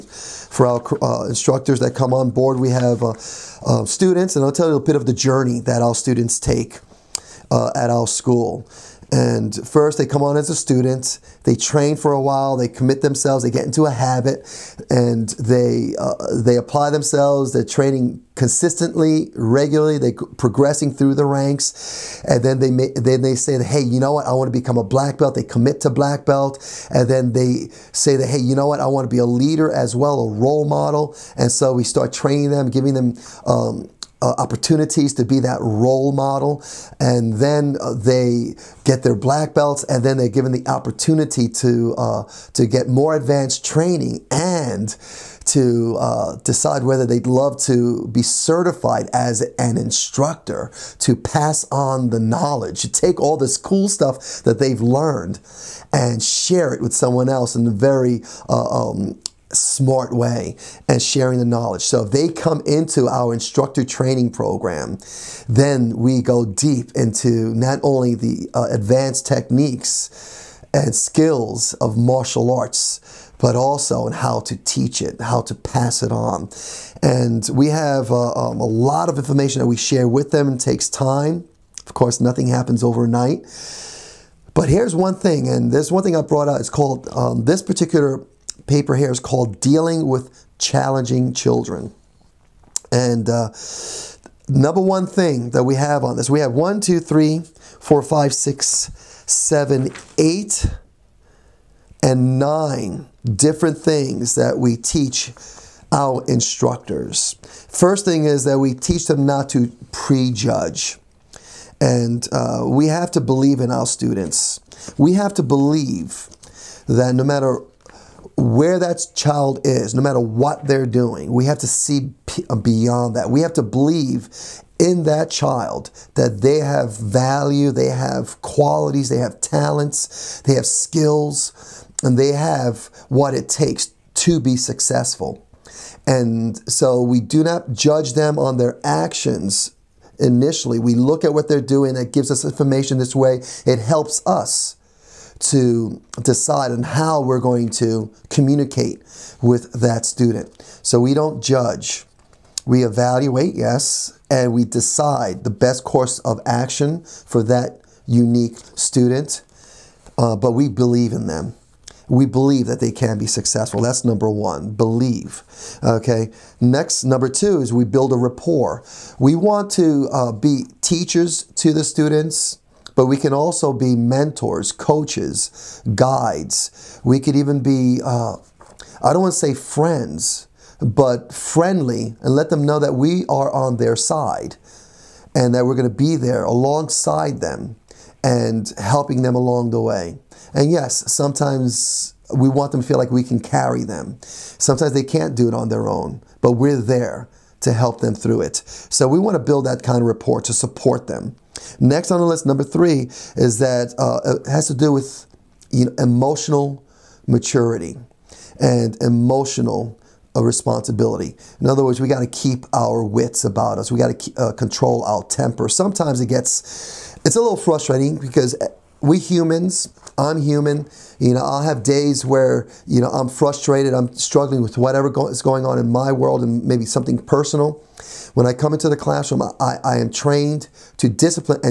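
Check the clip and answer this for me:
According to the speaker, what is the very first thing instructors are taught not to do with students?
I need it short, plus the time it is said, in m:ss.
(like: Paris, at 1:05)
prejudge, at 1:49.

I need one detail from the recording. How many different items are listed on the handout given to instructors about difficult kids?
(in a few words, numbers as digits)
9.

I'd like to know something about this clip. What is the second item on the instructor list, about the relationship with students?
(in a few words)
build a rapport.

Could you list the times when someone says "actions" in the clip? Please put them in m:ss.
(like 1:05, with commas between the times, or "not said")
2:18, 2:36.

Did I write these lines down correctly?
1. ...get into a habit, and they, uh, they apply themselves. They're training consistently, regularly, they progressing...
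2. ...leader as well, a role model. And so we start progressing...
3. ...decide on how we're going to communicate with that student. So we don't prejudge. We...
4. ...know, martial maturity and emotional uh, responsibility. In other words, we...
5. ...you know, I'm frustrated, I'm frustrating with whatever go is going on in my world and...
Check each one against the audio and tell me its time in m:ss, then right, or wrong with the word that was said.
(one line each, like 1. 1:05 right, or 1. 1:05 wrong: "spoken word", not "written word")
1. 0:13 right
2. 0:29 wrong: "training", not "progressing"
3. 2:26 wrong: "judge", not "prejudge"
4. 3:25 wrong: "emotional", not "martial"
5. 3:42 wrong: "struggling", not "frustrating".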